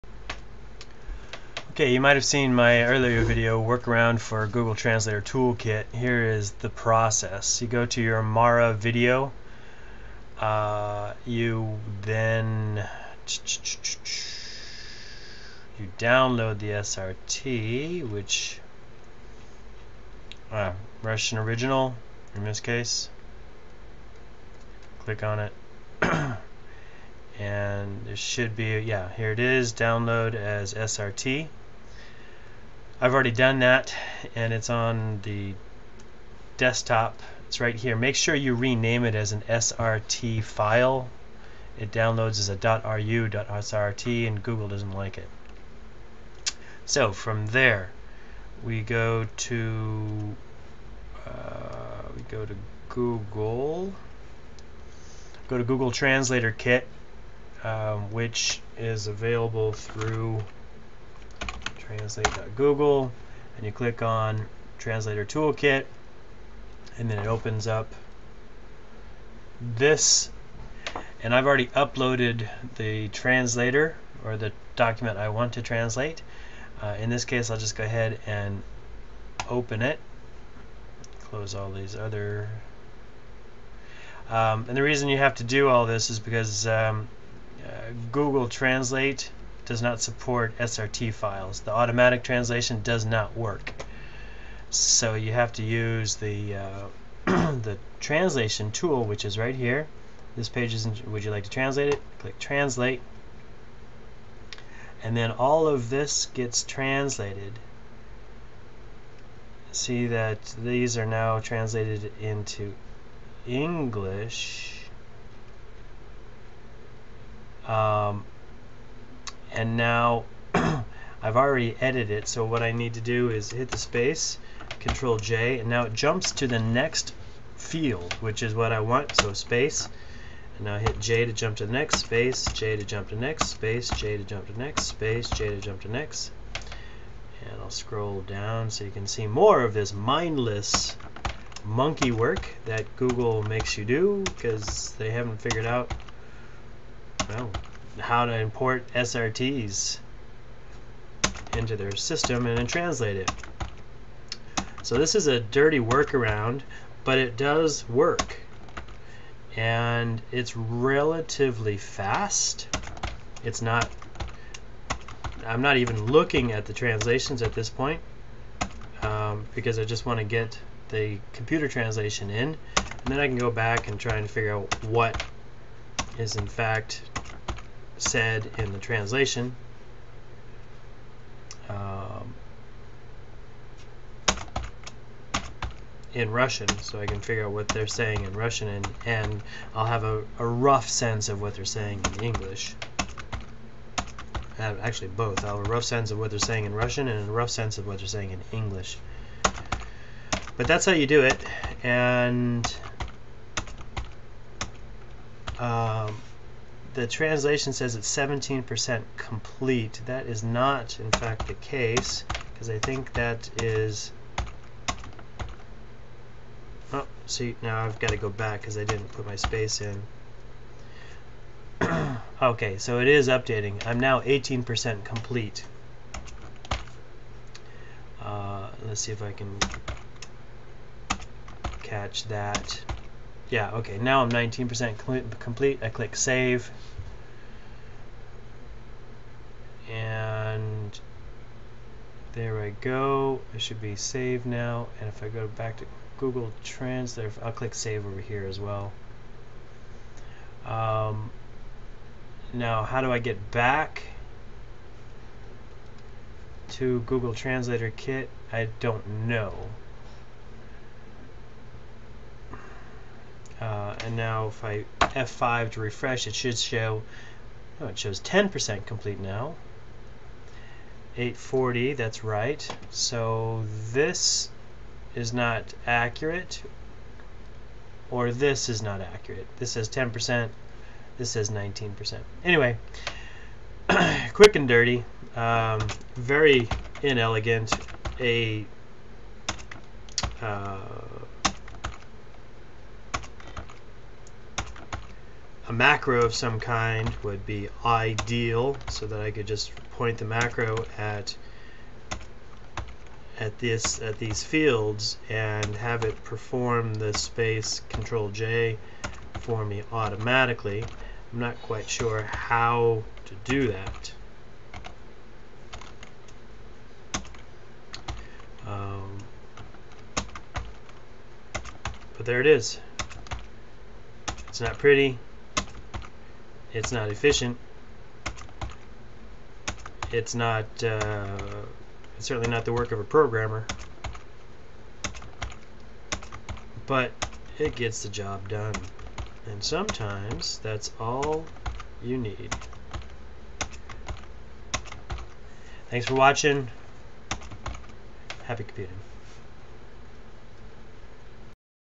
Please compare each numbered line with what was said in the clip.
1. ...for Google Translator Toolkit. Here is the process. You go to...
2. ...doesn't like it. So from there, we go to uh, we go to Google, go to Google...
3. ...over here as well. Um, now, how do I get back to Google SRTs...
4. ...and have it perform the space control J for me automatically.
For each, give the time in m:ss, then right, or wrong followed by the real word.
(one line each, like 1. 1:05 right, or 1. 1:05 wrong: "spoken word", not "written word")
1. 0:04 right
2. 0:44 right
3. 4:08 wrong: "Translator", not "SRTs"
4. 5:05 right.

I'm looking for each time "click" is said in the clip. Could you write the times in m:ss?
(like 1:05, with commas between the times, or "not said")
0:25, 1:03, 1:42, 3:55, 4:07.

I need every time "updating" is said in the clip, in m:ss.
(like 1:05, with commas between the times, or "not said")
3:43.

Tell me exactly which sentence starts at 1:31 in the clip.
The automatic translation does not work.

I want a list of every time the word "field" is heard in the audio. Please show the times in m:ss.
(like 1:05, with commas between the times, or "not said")
2:07, 5:04.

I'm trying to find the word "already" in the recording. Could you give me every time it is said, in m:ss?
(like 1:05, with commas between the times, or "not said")
0:33, 1:11, 2:01.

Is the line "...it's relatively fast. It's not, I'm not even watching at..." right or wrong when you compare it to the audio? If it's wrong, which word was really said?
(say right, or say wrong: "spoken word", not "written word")
wrong: "looking", not "watching".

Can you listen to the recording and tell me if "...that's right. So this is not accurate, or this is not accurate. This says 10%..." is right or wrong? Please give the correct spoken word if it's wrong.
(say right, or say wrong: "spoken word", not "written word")
right.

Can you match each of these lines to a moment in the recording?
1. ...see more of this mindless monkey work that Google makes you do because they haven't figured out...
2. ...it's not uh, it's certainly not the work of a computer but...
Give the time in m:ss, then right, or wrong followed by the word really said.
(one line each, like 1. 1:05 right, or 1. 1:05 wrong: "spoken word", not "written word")
1. 2:19 right
2. 5:30 wrong: "programmer", not "computer".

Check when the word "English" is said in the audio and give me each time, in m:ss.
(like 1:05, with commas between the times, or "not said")
1:53, 3:12, 3:18.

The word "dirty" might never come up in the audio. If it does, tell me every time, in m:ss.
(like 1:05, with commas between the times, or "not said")
2:35, 4:44.